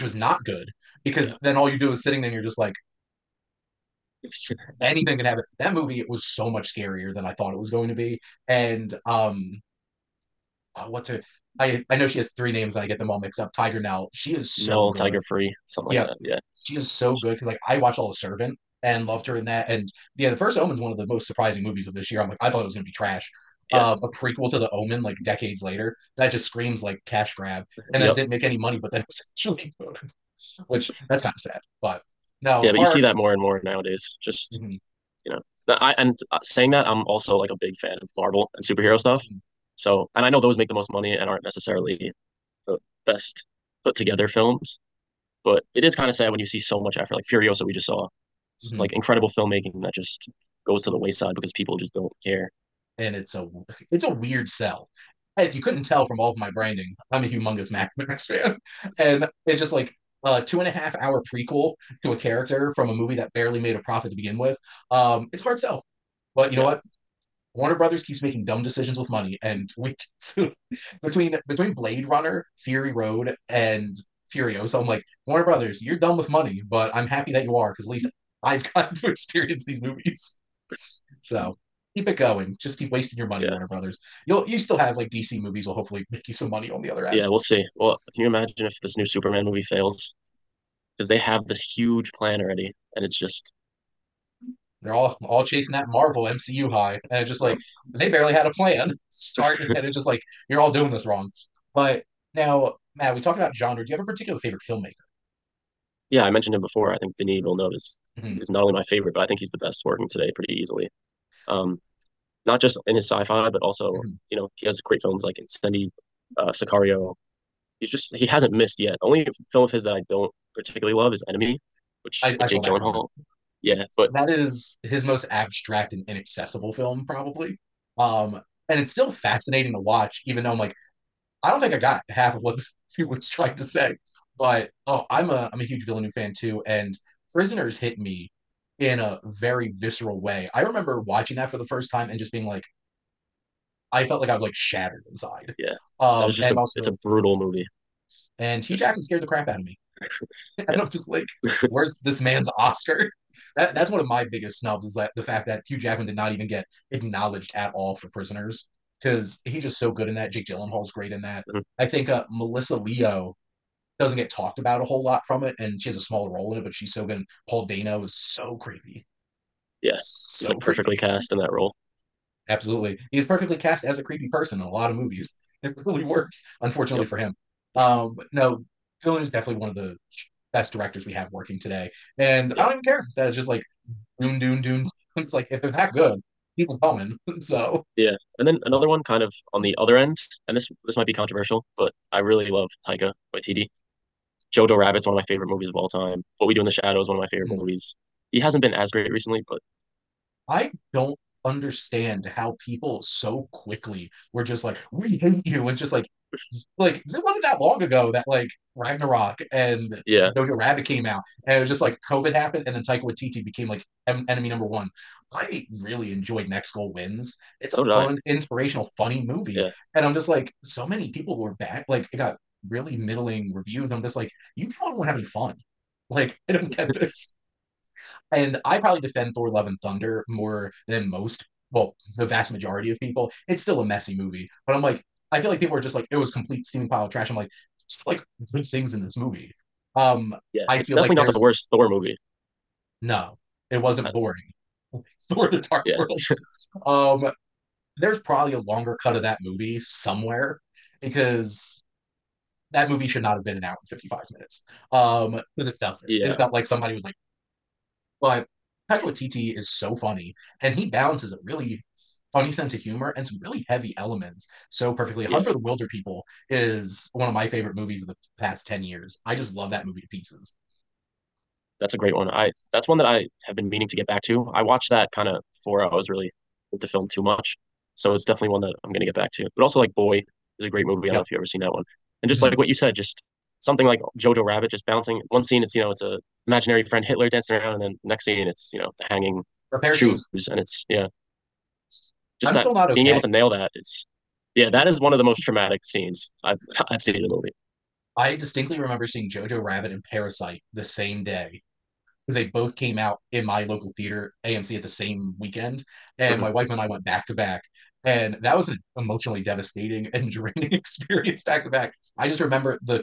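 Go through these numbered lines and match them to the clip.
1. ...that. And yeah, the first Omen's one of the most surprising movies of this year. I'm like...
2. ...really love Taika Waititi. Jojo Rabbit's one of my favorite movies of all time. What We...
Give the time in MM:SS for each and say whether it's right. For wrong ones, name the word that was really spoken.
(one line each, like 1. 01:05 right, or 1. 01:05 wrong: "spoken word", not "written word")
1. 00:19 right
2. 03:12 right.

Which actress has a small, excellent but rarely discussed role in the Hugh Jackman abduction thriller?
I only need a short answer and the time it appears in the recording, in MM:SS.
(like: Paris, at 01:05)
Melissa Leo, at 02:42.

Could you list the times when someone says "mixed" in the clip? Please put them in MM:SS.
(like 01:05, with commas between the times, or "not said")
00:13.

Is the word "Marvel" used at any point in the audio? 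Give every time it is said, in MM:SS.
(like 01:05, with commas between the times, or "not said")
00:38, 01:35.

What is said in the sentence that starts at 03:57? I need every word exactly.
I'm like, still like good things in this movie.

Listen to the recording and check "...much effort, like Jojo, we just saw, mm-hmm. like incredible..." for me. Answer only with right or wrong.
wrong.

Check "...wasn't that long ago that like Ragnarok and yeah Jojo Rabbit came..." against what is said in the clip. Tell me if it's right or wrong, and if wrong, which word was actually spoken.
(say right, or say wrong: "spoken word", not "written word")
right.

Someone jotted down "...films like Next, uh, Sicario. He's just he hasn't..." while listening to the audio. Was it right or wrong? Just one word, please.
wrong.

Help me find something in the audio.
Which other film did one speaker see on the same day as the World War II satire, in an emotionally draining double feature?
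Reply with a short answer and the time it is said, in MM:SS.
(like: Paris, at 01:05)
Parasite, at 05:00.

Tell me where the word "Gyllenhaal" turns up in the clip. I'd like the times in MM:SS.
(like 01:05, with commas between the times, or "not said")
02:02, 02:40.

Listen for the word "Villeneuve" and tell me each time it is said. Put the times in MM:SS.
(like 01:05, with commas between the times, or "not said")
01:47, 02:15.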